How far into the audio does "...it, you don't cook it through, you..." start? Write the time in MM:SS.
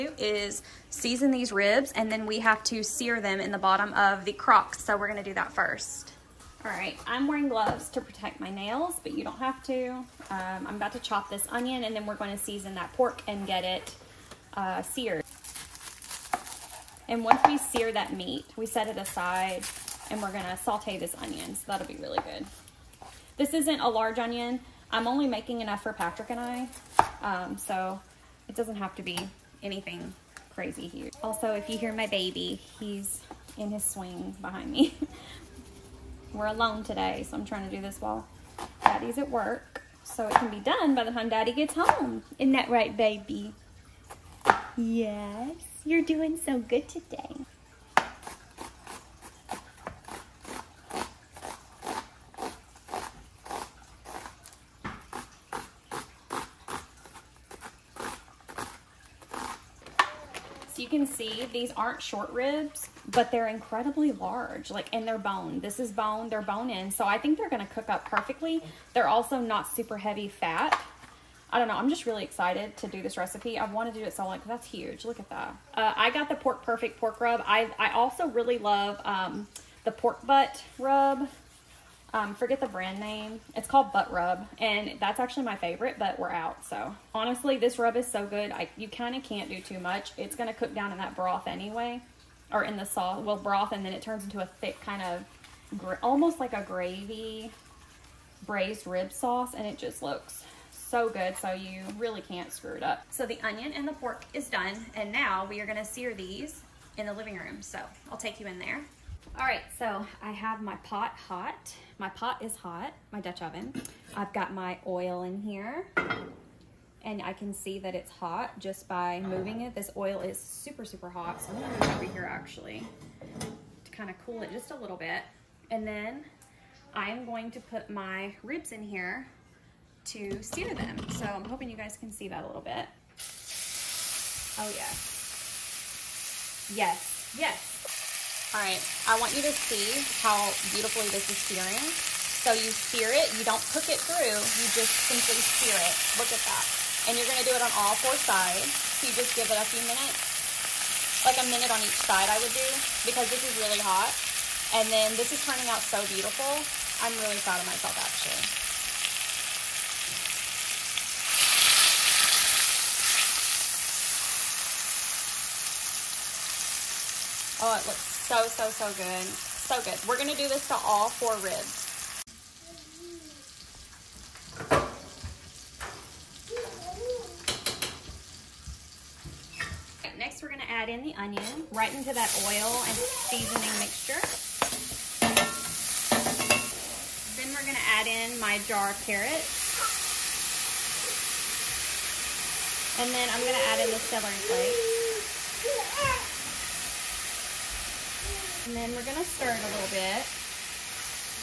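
02:23.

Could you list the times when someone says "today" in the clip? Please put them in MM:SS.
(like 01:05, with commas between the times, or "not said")
00:36, 00:46.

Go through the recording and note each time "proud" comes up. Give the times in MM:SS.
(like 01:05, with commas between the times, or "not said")
02:37.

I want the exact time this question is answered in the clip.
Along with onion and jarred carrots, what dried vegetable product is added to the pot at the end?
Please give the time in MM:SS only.
03:14.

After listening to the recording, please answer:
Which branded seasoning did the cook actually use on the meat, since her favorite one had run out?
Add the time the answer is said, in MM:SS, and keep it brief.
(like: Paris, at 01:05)
Pork Perfect, at 01:16.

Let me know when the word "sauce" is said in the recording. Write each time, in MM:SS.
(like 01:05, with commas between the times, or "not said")
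01:32, 01:39.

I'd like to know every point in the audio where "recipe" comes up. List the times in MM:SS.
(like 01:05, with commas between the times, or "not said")
01:13.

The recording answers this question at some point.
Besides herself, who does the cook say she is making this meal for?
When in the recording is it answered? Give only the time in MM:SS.
00:25.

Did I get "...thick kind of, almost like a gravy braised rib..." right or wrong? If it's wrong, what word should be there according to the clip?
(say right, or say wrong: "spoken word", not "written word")
right.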